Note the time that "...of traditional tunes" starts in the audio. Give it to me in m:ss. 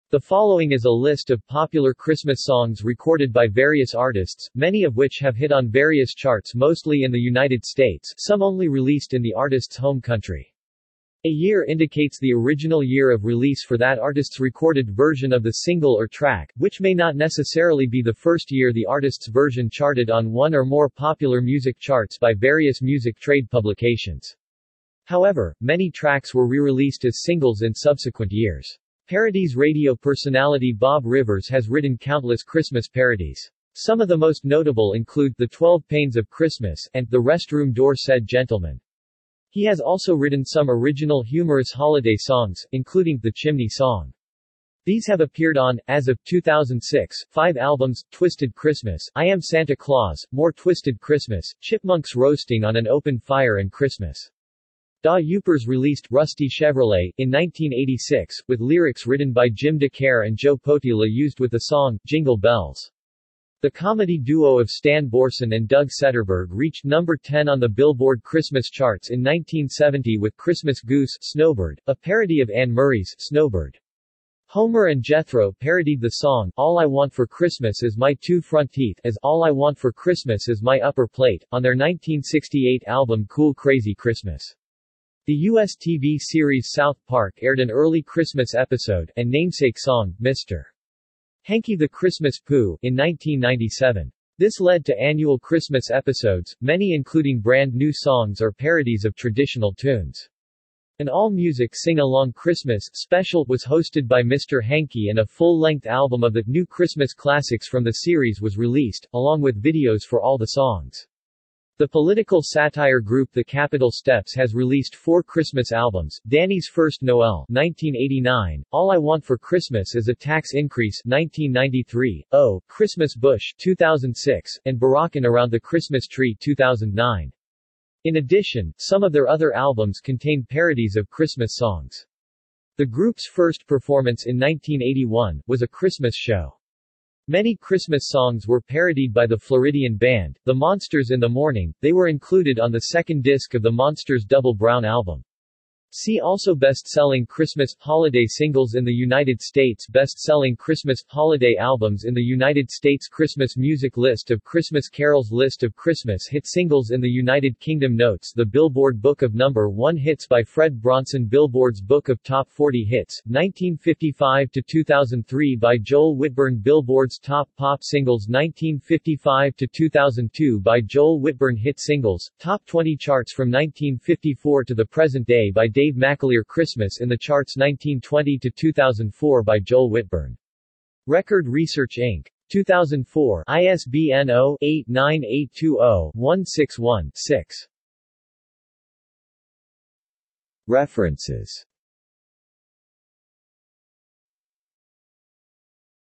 1:39.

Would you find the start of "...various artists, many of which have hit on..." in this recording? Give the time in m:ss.
0:03.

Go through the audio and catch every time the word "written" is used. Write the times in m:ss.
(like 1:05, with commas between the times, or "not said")
0:31, 0:40, 0:59.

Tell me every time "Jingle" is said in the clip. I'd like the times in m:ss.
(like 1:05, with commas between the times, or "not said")
1:02.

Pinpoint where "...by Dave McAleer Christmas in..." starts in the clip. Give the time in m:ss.
2:55.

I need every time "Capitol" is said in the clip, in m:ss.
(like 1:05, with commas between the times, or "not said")
1:53.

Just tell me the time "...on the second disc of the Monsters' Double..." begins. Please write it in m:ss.
2:22.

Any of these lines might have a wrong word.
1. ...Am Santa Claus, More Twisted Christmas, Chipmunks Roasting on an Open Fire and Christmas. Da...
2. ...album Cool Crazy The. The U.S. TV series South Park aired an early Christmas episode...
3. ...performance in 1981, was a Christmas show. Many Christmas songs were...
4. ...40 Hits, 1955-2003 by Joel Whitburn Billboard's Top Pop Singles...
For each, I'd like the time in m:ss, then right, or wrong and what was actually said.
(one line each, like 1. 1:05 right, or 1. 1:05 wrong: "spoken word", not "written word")
1. 0:49 right
2. 1:22 wrong: "Christmas", not "The"
3. 2:13 right
4. 2:42 right.